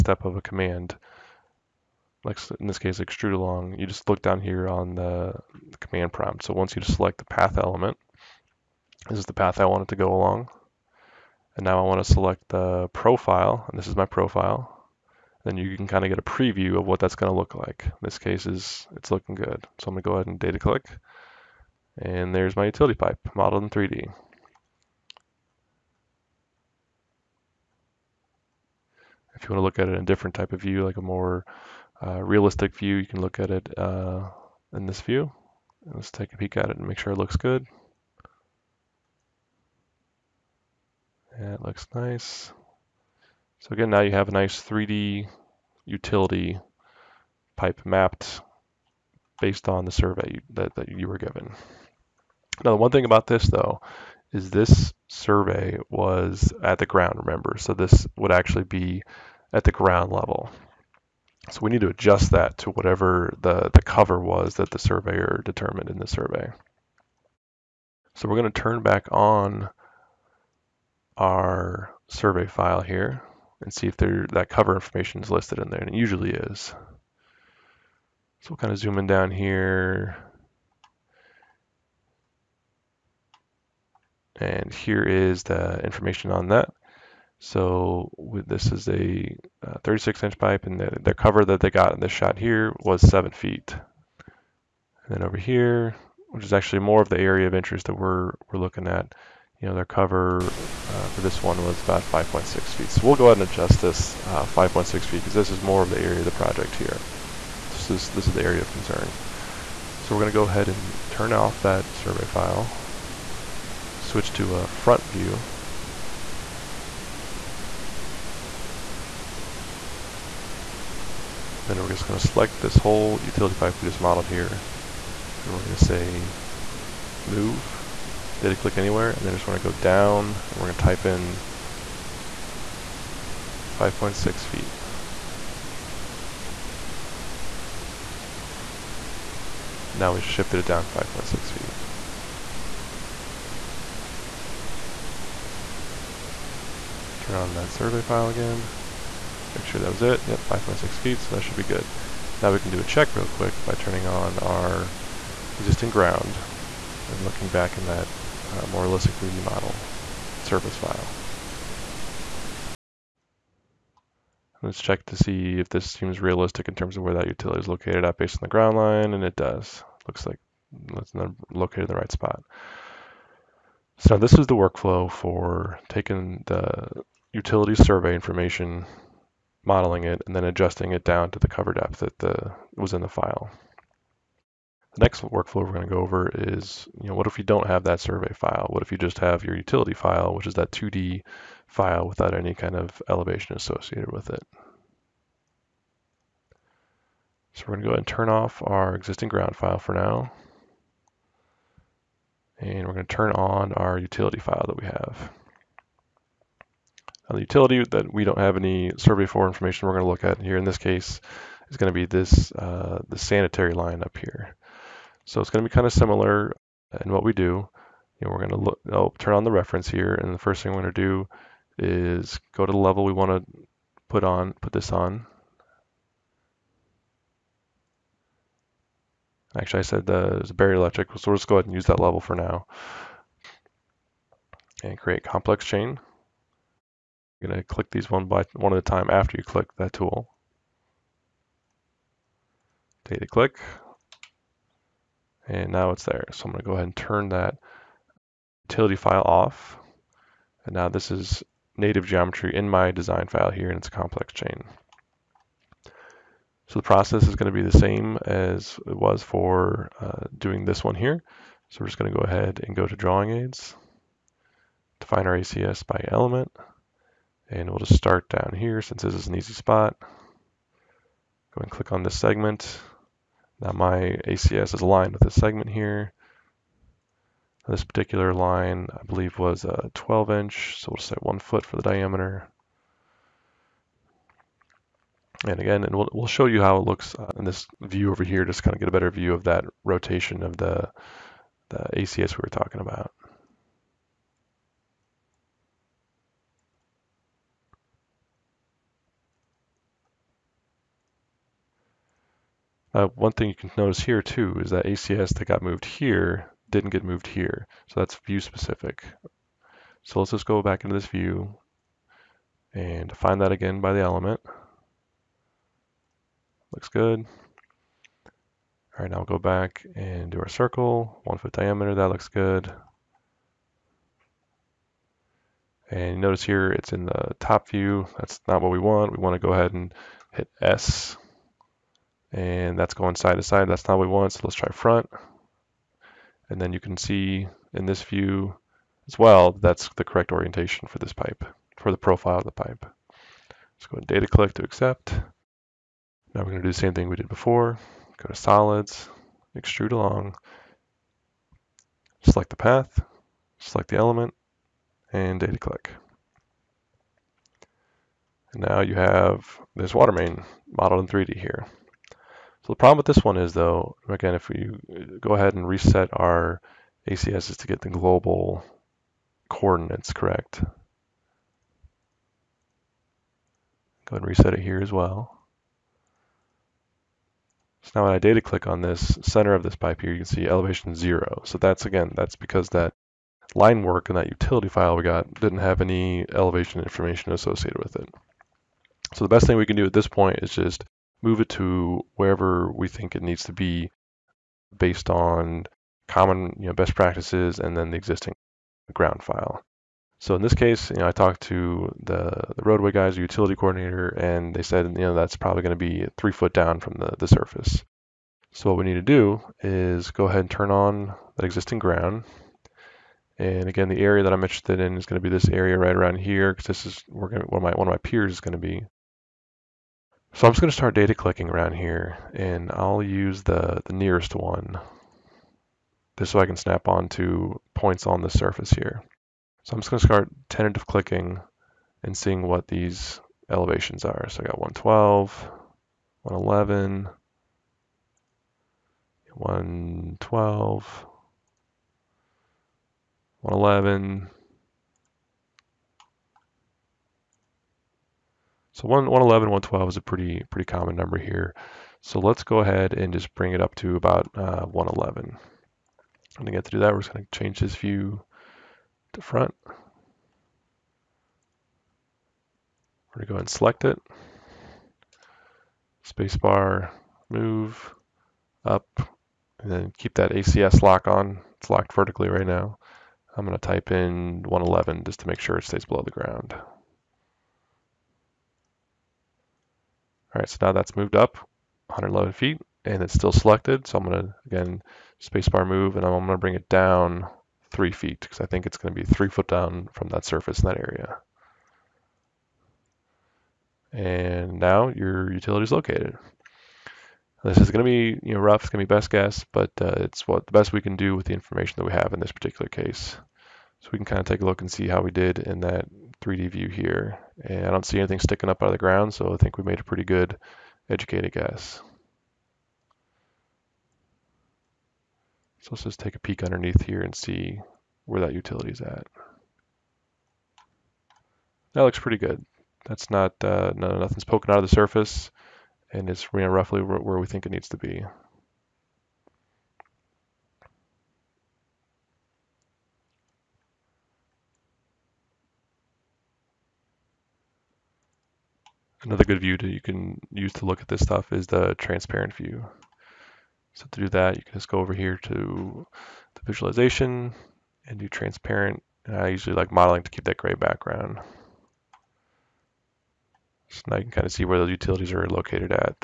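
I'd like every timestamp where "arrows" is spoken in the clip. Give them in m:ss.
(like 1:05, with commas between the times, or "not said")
not said.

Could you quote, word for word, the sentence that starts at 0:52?
Now, the one thing about this though is this survey was at the ground, remember?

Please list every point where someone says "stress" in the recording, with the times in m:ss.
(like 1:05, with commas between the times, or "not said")
not said.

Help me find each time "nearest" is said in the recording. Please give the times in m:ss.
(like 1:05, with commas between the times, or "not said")
7:03.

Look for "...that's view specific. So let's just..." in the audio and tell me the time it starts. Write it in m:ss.
5:07.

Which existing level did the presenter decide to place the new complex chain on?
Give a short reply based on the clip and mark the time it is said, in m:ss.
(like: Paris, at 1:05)
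buried electric, at 3:50.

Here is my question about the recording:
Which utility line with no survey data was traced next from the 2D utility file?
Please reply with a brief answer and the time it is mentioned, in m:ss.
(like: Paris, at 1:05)
sanitary line, at 3:33.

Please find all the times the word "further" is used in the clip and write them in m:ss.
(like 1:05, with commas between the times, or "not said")
not said.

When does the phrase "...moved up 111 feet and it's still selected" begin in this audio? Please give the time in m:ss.
8:00.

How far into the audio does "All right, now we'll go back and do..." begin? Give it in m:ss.
5:18.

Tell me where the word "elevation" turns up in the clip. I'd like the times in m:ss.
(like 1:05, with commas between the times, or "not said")
3:13, 6:20, 6:26, 7:13.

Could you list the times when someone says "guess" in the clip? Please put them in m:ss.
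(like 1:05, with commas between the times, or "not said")
8:19, 8:31.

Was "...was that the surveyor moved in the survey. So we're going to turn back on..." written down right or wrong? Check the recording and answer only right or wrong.
wrong.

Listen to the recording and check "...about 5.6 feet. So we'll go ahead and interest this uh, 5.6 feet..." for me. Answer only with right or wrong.
wrong.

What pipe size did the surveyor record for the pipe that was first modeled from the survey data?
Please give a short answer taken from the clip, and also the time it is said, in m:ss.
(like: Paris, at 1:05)
36 inch, at 1:29.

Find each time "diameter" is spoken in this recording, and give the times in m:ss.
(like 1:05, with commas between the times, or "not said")
4:41, 5:21.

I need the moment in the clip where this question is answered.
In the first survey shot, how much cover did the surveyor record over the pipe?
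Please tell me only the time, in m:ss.
1:33.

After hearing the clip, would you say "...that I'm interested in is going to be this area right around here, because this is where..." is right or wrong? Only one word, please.
right.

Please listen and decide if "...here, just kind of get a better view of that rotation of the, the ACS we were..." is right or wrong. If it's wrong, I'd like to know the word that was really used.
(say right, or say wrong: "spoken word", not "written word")
right.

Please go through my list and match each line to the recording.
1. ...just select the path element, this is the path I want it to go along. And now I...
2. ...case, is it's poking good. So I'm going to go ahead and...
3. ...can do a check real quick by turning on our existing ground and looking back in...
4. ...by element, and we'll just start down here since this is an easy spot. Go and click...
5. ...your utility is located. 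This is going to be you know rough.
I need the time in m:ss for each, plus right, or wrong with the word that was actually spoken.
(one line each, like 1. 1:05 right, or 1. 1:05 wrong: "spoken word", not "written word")
1. 0:06 right
2. 0:18 wrong: "looking", not "poking"
3. 2:32 right
4. 4:25 right
5. 8:14 right.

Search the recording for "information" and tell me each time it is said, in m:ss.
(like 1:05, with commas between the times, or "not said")
1:14, 1:25, 2:58, 3:29, 6:26, 8:21.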